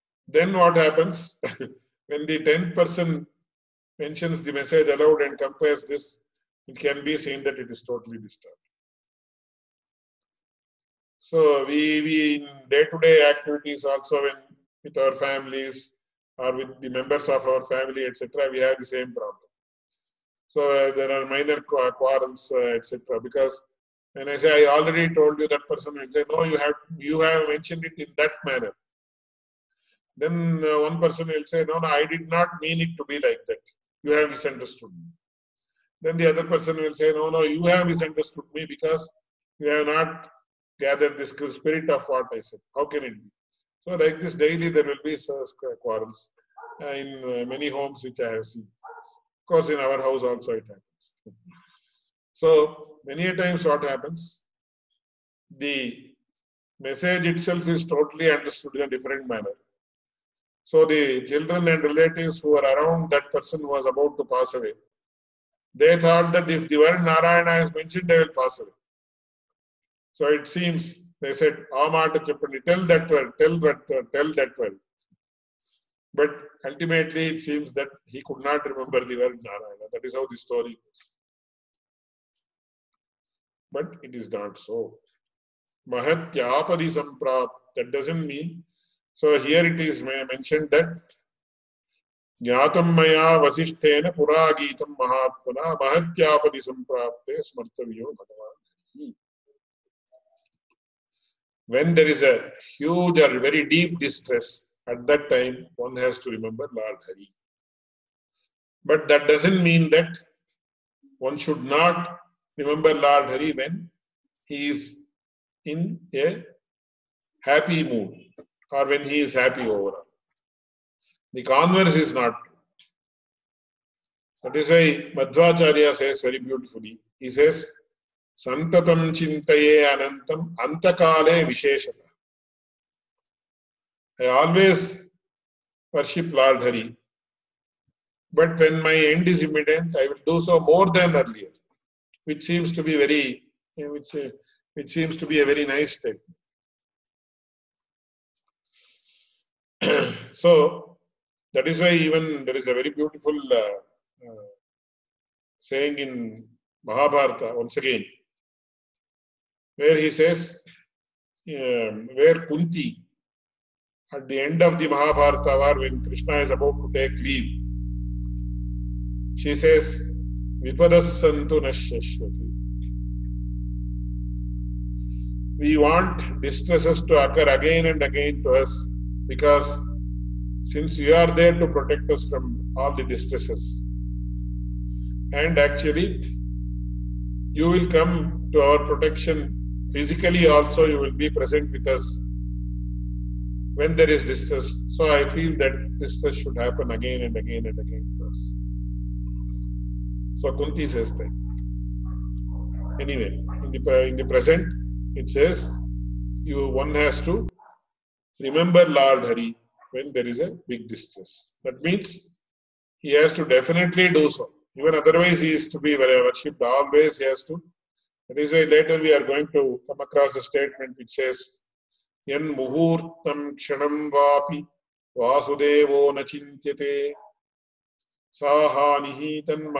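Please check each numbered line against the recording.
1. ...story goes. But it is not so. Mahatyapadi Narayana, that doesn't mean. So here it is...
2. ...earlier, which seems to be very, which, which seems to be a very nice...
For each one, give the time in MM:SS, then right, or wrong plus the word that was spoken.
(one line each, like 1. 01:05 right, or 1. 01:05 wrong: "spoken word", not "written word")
1. 01:20 wrong: "Samprap", not "Narayana"
2. 02:21 right.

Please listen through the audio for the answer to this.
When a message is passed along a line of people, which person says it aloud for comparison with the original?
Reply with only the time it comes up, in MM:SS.
00:02.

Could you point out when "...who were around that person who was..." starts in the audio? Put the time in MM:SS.
01:02.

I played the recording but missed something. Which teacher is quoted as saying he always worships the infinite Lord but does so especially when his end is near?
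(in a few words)
Madhvacharya.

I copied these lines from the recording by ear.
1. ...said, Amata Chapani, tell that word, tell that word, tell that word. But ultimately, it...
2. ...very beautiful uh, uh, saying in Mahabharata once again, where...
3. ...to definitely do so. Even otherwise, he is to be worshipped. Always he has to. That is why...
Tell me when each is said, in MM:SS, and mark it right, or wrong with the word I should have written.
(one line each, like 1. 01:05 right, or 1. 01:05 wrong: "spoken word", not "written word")
1. 01:11 right
2. 02:32 right
3. 03:33 right.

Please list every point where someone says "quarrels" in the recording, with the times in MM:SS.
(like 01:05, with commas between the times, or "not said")
00:21, 00:45.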